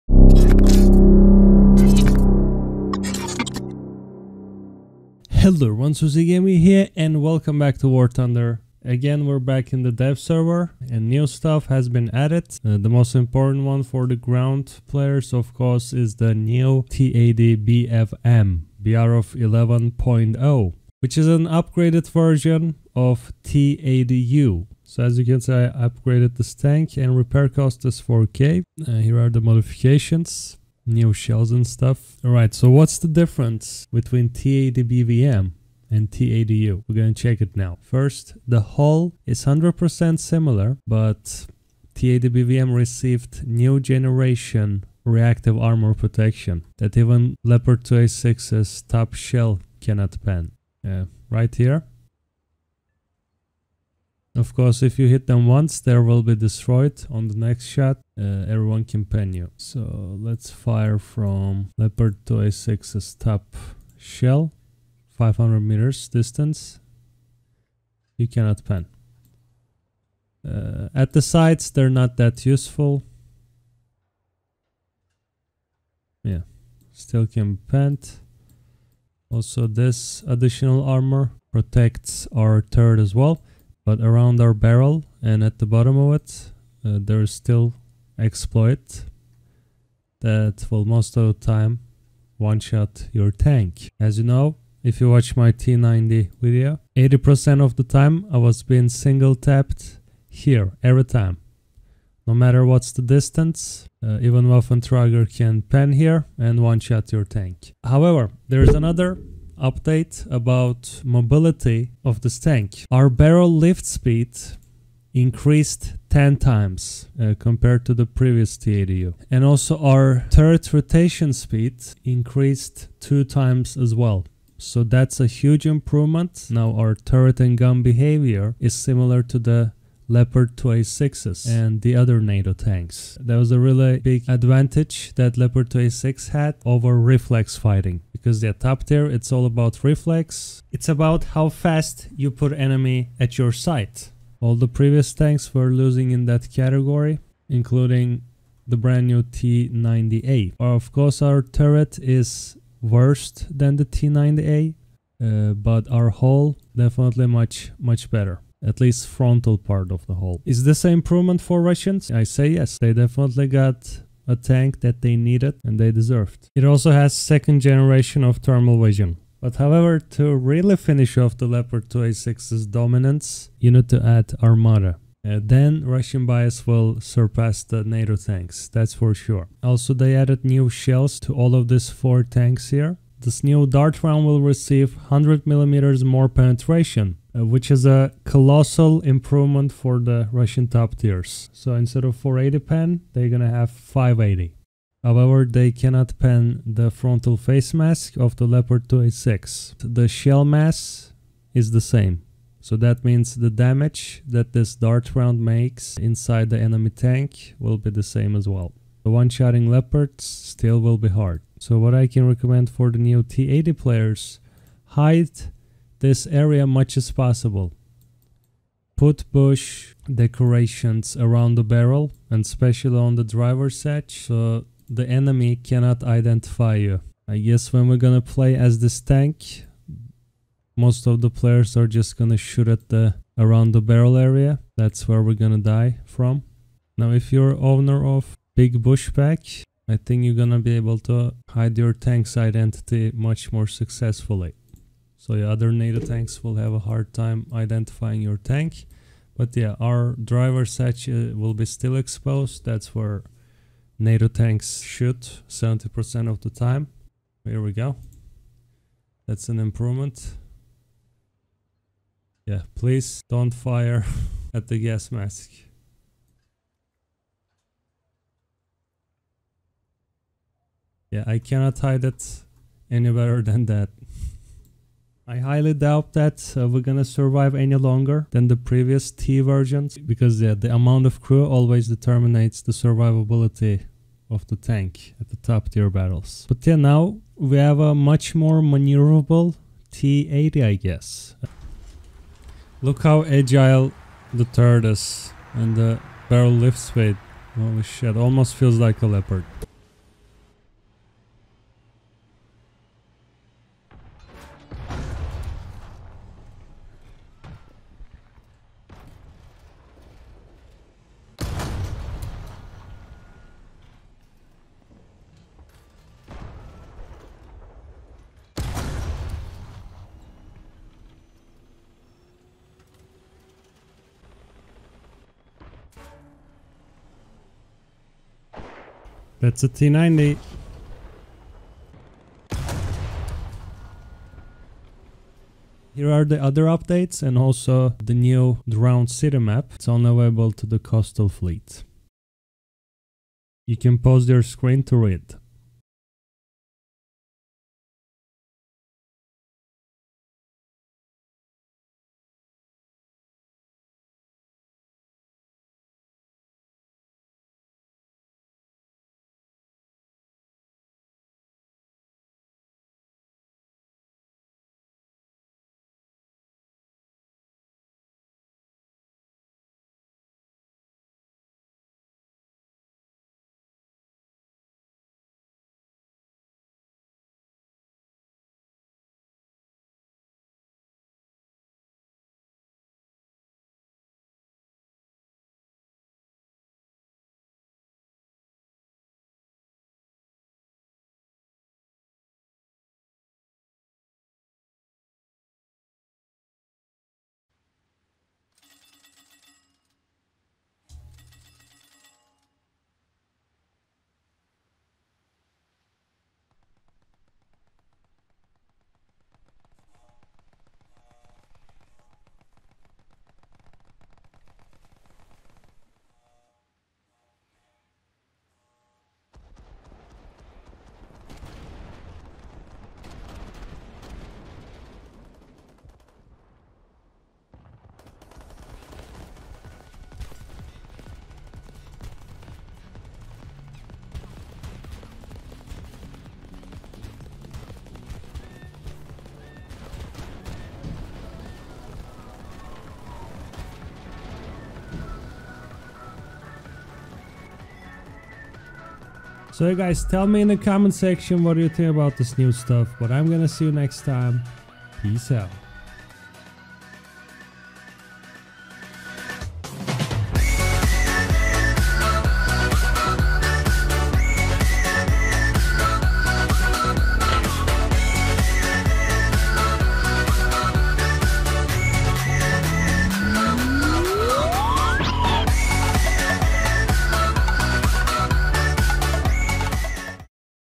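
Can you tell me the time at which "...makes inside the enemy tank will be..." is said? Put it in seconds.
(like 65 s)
205 s.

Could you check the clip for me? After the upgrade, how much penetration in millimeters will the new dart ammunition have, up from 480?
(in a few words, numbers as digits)
580.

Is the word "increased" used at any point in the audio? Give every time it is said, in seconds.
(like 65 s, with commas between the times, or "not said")
115 s, 122 s.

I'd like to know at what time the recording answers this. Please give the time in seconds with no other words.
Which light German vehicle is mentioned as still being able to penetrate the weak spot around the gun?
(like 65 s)
104 s.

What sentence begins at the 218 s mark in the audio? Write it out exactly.
Put bush decorations around the barrel and especially on the driver's edge so the enemy cannot identify you.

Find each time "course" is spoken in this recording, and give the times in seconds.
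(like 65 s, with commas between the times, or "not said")
15 s, 54 s, 150 s.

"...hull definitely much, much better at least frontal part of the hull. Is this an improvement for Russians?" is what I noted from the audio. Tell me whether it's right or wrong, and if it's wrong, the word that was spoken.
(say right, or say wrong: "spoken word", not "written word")
right.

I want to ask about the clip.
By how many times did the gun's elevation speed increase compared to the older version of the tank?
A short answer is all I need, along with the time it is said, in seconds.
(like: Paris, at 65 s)
10 times, at 116 s.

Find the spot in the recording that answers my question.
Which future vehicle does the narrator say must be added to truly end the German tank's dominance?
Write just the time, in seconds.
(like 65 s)
174 s.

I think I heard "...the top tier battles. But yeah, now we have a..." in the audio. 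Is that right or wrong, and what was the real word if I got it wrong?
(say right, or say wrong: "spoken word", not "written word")
right.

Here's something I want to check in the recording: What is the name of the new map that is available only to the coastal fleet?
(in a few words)
Drowned City.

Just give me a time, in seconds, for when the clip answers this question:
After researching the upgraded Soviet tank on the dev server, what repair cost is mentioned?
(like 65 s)
27 s.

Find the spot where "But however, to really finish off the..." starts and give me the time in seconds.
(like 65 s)
169 s.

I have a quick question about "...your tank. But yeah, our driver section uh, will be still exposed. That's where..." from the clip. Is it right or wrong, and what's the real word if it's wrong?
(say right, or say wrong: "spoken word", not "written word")
right.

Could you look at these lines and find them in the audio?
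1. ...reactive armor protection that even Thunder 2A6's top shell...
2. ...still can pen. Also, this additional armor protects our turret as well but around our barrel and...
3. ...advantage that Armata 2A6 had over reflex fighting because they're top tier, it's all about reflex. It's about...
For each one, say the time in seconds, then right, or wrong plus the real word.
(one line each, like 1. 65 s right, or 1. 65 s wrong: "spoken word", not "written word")
1. 45 s wrong: "Leopard", not "Thunder"
2. 76 s right
3. 134 s wrong: "Leopard", not "Armata".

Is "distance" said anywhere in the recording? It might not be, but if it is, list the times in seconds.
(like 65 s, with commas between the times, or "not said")
66 s, 103 s.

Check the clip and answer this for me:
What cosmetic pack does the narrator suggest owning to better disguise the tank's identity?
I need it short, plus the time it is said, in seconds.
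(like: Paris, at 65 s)
big bush pack, at 238 s.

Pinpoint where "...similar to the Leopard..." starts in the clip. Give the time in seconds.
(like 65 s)
128 s.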